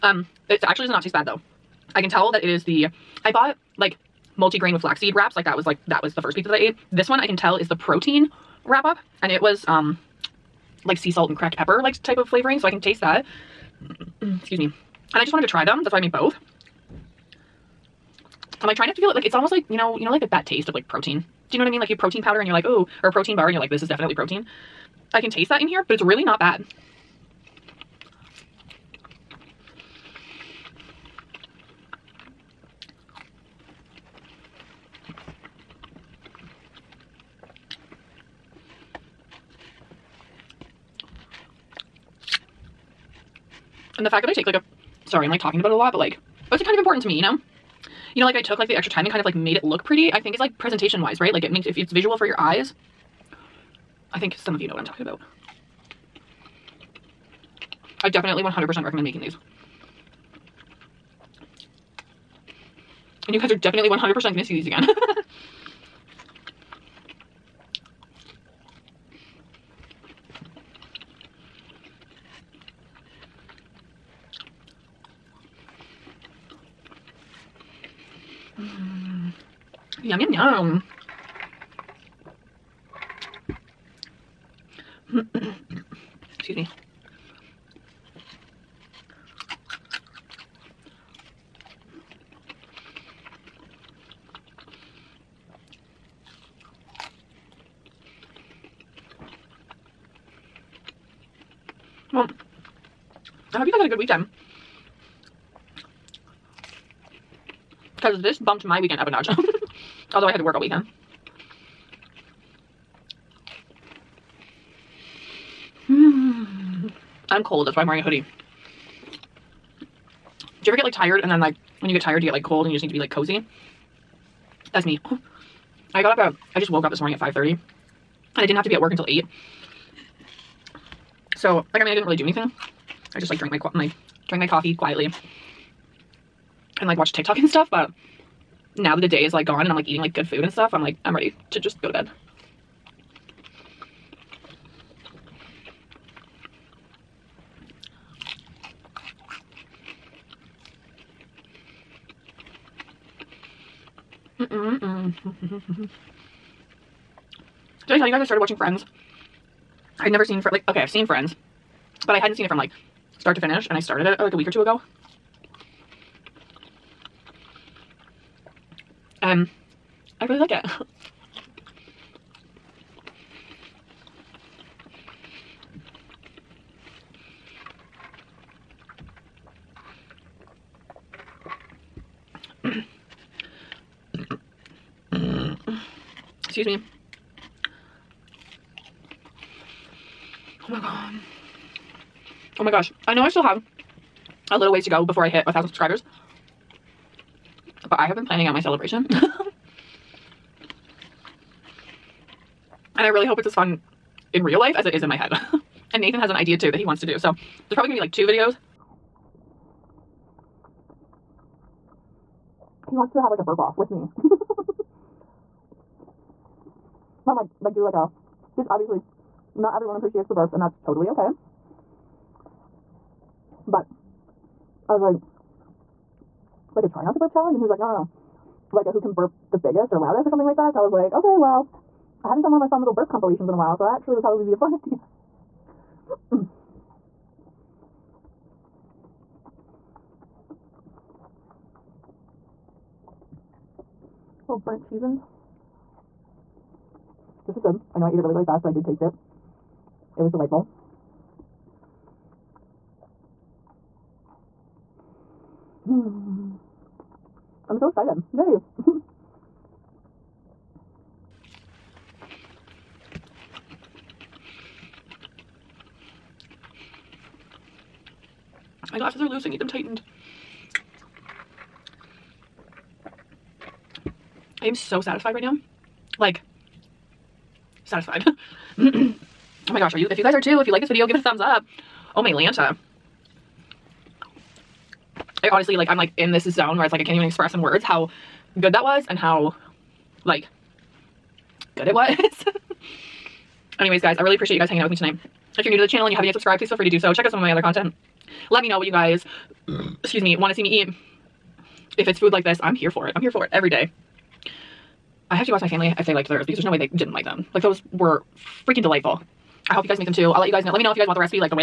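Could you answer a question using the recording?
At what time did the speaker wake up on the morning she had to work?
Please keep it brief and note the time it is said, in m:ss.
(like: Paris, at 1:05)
5:30, at 2:07.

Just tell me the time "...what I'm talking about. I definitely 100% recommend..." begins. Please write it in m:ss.
0:54.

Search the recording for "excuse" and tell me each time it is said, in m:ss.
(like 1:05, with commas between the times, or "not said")
0:14, 3:06, 5:00.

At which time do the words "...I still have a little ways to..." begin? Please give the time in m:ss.
3:13.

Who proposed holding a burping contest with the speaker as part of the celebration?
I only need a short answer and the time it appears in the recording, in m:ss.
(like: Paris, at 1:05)
Nathan, at 3:26.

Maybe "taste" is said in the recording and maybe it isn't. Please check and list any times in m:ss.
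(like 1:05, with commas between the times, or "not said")
0:01, 0:12, 0:20, 0:25, 4:08.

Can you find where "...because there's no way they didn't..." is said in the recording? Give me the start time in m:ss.
5:06.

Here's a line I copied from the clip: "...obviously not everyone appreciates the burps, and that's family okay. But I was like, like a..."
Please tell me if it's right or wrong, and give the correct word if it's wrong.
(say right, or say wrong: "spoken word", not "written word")
wrong: "totally", not "family".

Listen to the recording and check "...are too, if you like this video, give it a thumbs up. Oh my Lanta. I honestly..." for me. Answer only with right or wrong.
right.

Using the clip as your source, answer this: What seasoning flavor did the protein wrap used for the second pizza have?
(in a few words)
Sea salt and cracked pepper.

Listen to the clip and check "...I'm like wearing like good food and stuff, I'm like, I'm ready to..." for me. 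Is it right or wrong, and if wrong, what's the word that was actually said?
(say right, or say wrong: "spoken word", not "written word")
wrong: "eating", not "wearing".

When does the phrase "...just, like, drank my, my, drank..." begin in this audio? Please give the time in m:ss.
2:13.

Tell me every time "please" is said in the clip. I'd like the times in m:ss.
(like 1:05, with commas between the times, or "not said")
4:56.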